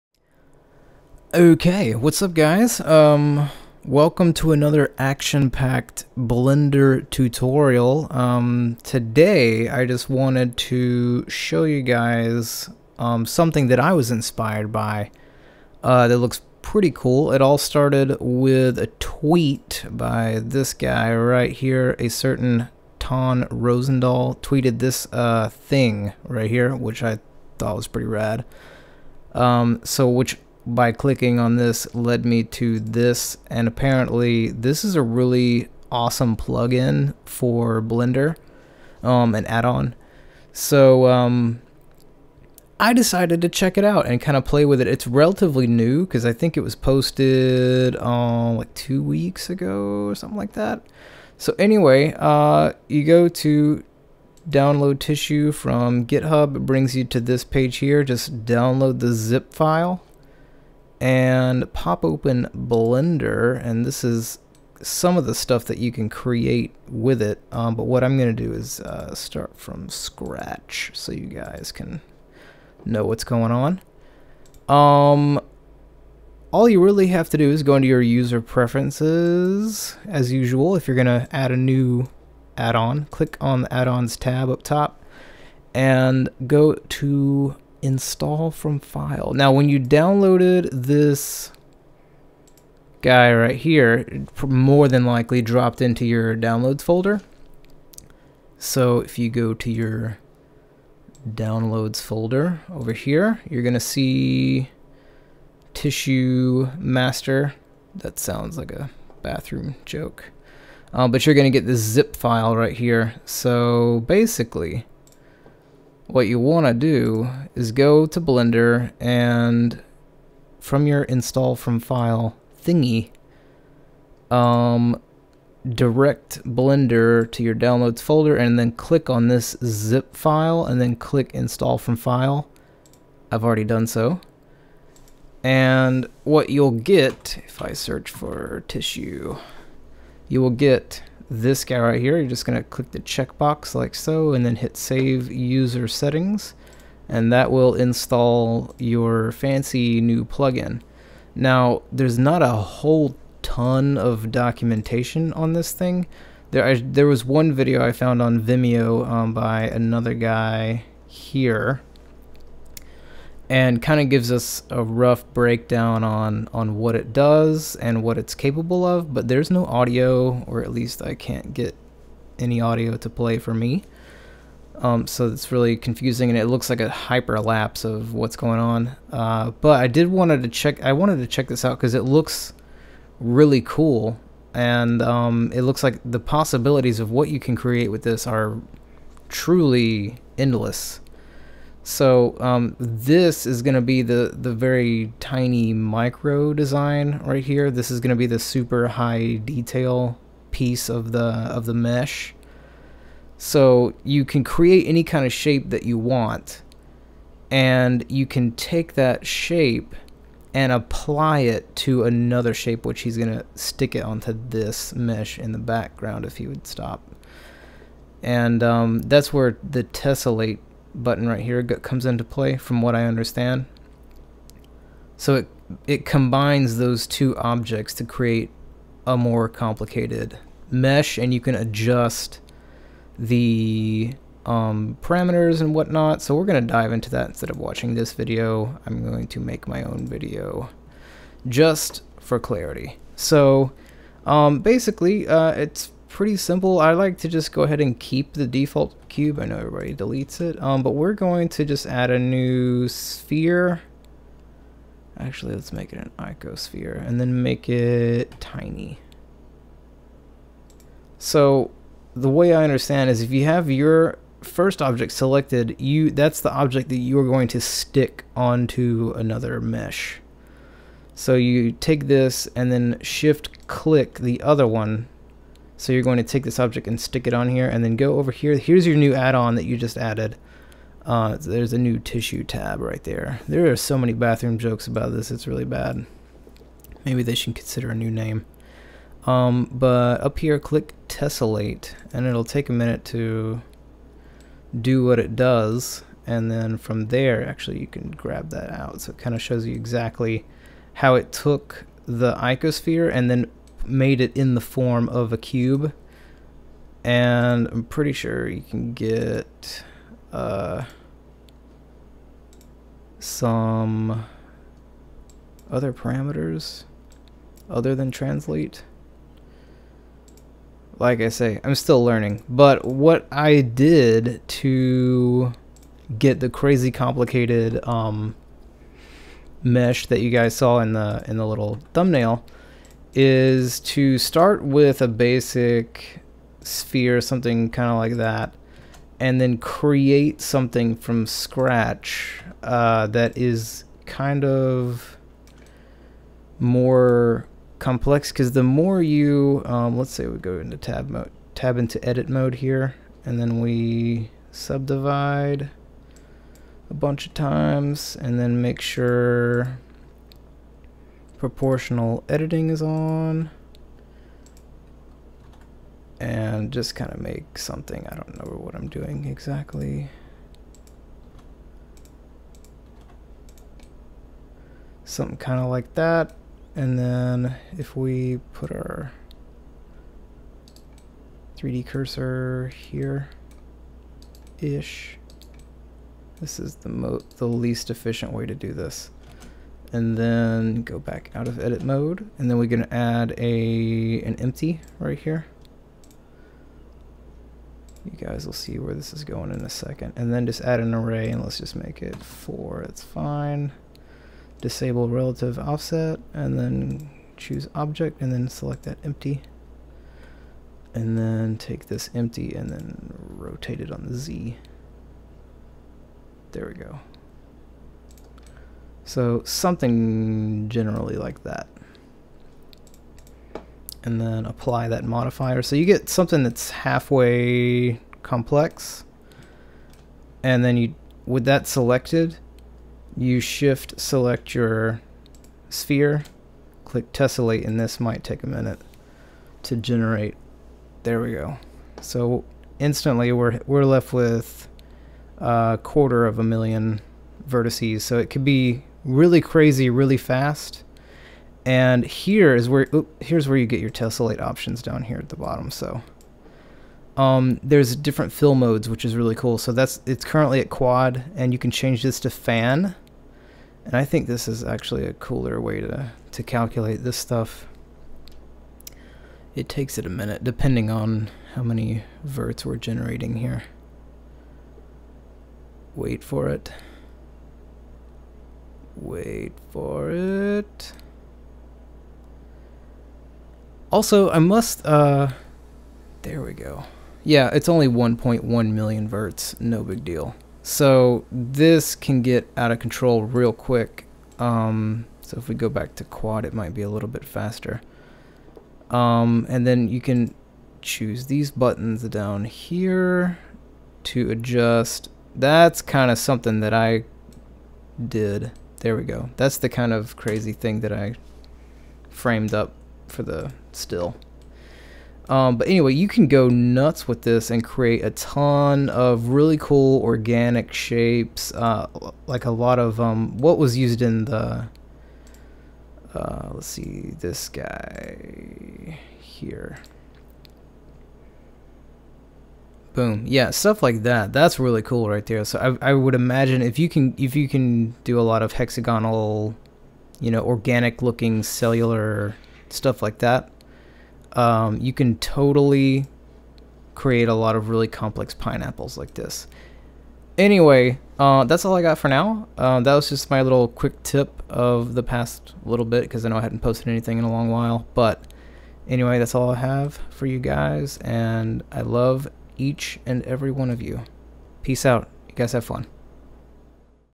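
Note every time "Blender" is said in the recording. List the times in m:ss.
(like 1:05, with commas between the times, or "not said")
0:06, 0:37, 1:02, 1:58, 2:06.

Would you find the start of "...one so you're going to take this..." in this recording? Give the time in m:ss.
4:34.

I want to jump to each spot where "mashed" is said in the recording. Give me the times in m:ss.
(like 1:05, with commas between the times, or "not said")
not said.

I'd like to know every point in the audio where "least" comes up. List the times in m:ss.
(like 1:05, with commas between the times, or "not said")
2:50, 6:27.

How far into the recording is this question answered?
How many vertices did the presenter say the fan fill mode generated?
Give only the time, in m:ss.
8:07.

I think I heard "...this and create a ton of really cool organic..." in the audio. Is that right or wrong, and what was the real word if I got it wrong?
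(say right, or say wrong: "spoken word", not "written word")
right.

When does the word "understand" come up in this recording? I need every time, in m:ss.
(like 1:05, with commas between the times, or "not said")
3:43, 4:22.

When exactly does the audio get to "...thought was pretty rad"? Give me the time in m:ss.
0:27.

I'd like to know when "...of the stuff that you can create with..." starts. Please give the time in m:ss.
1:05.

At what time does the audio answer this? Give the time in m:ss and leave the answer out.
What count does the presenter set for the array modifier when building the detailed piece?
6:42.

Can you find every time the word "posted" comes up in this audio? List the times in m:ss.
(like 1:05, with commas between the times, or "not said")
0:46, 9:16.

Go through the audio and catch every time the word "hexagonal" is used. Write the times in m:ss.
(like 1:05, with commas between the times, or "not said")
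8:58.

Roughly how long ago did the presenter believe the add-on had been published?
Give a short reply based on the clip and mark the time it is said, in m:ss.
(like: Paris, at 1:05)
2 weeks, at 0:48.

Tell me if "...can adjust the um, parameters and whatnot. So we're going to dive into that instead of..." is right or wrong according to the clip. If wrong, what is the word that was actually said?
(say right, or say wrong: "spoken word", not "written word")
right.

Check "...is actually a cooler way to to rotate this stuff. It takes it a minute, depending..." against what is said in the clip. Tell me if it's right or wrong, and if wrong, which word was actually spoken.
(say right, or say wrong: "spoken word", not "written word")
wrong: "calculate", not "rotate".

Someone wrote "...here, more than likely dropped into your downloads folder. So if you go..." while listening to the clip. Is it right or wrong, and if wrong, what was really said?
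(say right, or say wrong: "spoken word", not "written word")
right.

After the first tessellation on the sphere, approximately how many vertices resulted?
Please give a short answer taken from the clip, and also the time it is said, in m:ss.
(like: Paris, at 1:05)
a quarter of a million, at 7:25.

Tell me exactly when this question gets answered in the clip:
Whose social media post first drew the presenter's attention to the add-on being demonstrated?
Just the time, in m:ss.
0:22.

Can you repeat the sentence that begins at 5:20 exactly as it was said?
Like I say, I'm still learning.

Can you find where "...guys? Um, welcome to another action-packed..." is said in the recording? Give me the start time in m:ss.
0:02.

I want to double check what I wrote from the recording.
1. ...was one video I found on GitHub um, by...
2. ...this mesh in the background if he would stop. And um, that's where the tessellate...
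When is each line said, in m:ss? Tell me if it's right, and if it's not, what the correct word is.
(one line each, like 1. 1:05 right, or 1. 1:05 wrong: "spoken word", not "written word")
1. 2:37 wrong: "Vimeo", not "GitHub"
2. 3:34 right.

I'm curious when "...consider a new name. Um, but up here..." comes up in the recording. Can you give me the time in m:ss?
4:47.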